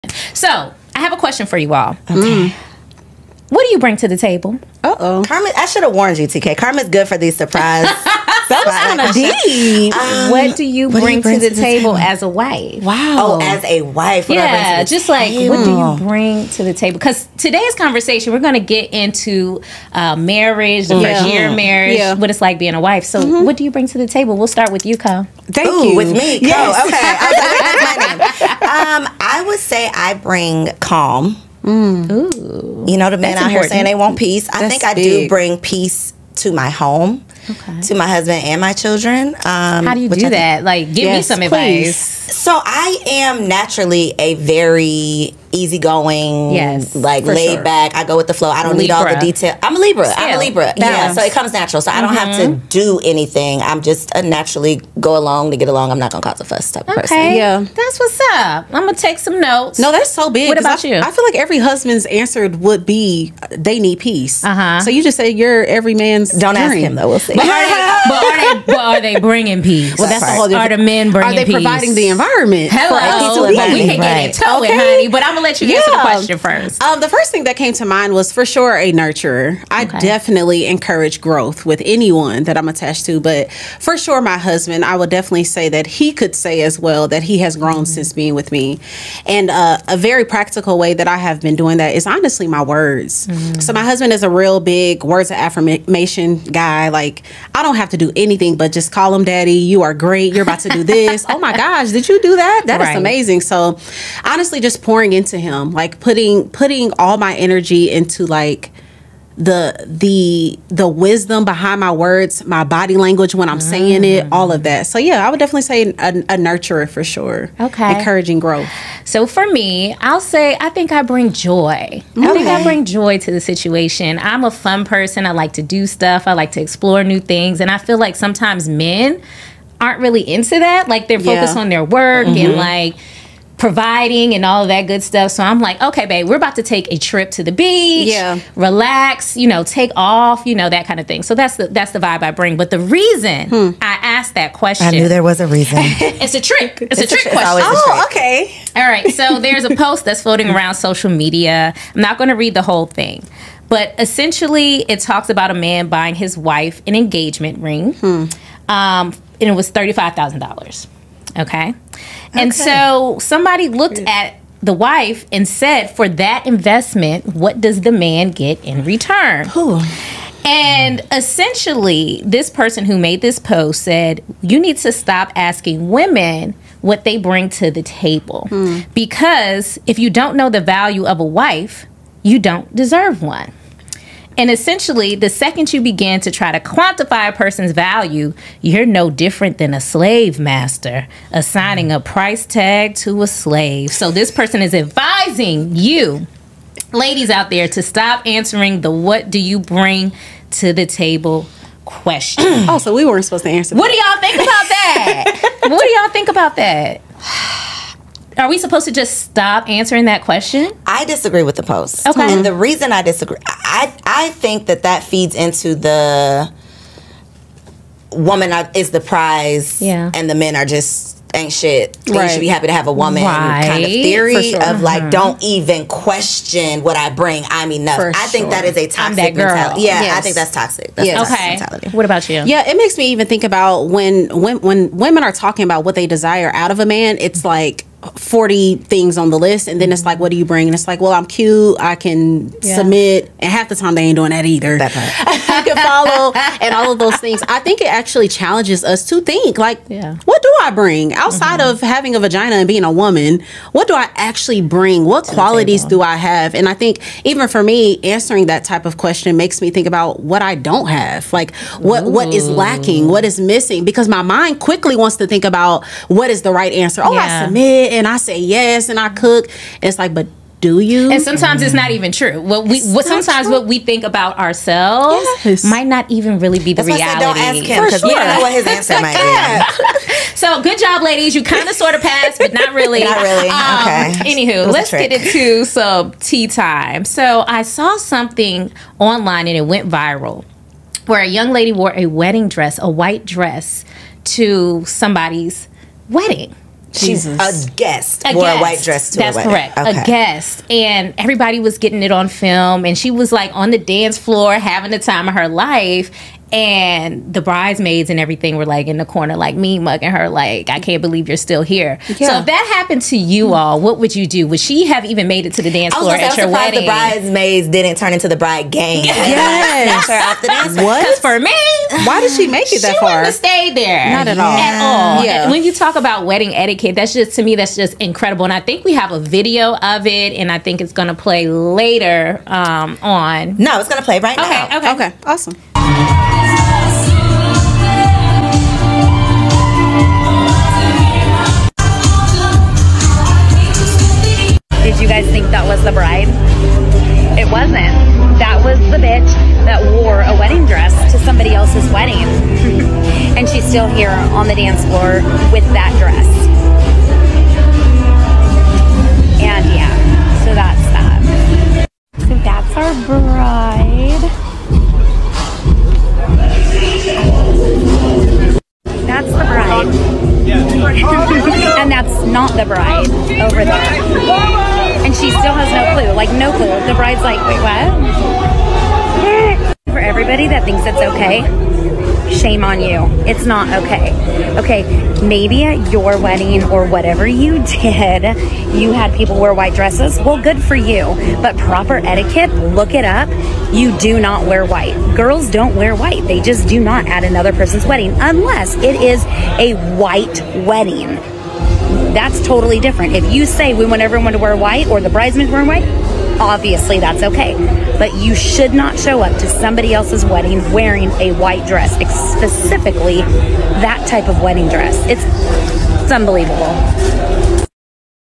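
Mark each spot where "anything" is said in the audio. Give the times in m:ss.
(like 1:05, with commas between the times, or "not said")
0:53, 1:38.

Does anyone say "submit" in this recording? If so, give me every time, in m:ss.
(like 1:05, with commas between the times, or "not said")
4:02, 4:27.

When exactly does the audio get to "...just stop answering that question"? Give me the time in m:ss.
3:28.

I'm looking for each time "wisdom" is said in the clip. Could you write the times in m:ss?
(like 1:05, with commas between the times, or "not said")
1:50.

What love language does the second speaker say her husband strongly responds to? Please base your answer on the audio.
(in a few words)
Words of affirmation.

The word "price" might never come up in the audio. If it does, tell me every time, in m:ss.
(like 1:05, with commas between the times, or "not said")
3:11.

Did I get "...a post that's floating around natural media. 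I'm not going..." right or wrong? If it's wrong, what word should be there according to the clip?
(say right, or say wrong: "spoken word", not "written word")
wrong: "social", not "natural".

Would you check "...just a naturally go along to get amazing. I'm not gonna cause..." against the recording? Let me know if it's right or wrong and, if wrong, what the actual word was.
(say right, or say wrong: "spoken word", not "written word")
wrong: "along", not "amazing".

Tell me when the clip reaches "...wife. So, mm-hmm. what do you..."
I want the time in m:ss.
0:22.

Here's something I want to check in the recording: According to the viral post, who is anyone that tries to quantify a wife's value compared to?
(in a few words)
A slave master.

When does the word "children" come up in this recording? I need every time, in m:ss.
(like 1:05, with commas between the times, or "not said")
0:38.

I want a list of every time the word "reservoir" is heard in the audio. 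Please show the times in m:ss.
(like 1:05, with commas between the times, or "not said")
not said.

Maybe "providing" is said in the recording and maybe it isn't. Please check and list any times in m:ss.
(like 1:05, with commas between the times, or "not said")
1:11, 2:13.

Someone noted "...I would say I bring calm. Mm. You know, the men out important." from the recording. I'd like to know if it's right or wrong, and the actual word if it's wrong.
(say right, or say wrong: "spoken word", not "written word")
right.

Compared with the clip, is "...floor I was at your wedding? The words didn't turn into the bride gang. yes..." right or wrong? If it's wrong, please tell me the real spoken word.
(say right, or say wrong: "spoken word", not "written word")
wrong: "bridesmaids", not "words".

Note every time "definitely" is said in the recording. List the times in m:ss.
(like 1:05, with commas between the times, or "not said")
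1:19, 1:25, 1:55.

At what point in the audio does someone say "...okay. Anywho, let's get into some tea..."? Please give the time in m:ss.
4:43.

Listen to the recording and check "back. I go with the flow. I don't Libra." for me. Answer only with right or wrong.
right.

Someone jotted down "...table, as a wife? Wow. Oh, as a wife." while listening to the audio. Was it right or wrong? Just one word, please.
right.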